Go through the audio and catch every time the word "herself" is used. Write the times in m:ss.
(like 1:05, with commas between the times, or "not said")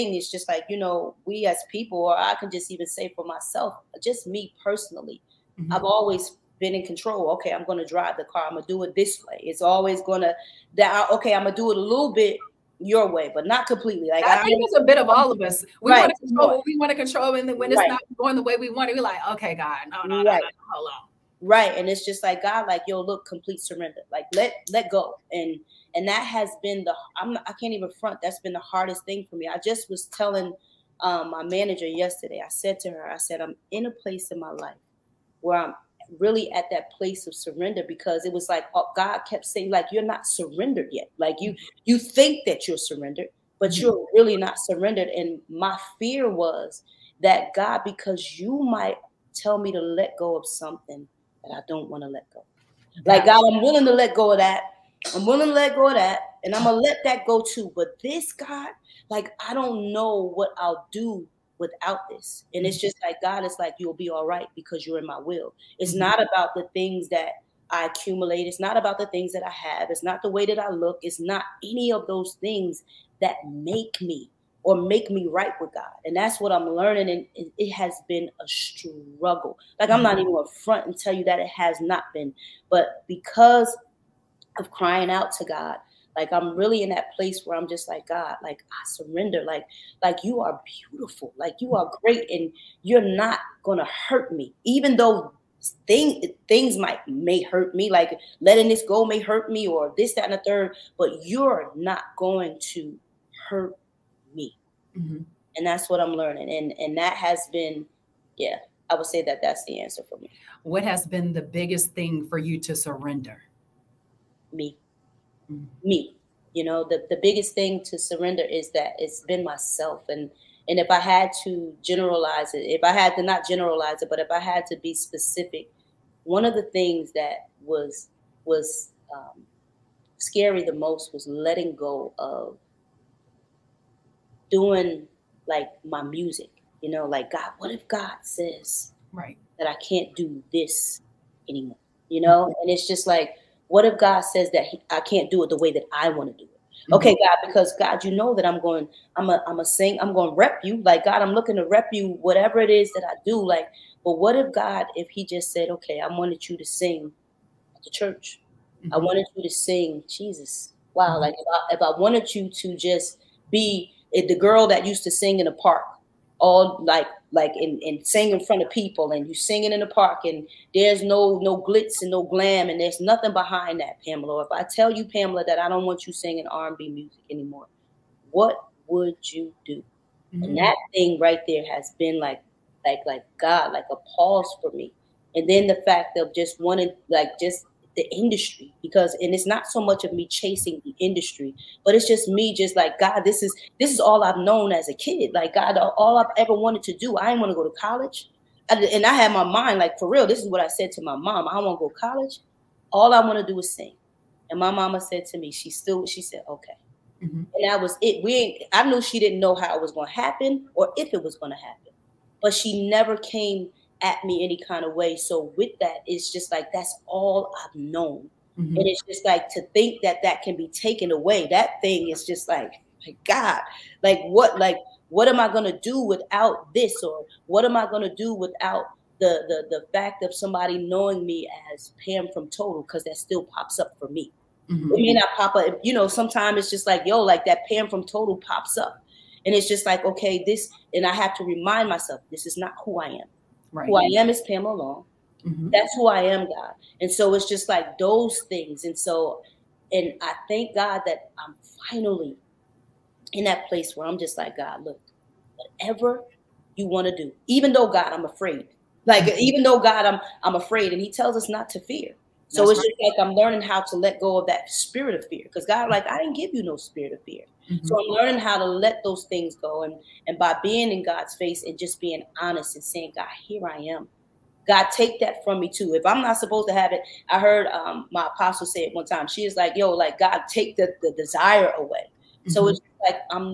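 not said.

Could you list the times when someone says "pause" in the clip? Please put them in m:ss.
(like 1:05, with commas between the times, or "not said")
3:04.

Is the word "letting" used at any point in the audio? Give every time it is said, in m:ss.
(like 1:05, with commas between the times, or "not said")
1:38, 2:11.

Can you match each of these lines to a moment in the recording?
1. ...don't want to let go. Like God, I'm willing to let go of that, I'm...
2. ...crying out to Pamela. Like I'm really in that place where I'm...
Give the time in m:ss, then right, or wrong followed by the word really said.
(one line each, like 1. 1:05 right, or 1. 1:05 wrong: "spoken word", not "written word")
1. 0:51 right
2. 1:24 wrong: "God", not "Pamela".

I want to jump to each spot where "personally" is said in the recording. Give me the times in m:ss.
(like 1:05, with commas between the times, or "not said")
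0:04.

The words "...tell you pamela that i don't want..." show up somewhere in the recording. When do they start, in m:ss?
2:54.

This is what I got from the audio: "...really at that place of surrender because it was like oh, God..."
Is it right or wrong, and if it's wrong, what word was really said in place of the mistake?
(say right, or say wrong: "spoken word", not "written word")
right.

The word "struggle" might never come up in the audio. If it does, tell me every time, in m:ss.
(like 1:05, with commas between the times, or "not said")
1:18.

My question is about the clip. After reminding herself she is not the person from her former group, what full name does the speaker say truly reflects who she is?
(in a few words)
Pamela Long.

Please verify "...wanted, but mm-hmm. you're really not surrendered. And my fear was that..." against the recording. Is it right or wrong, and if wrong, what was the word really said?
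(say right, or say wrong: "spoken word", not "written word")
wrong: "surrendered", not "wanted".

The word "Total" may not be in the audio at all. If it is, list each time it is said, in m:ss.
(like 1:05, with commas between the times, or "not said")
3:52, 3:58.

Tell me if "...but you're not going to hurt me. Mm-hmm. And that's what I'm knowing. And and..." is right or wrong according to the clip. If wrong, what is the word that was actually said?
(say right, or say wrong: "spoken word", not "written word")
wrong: "learning", not "knowing".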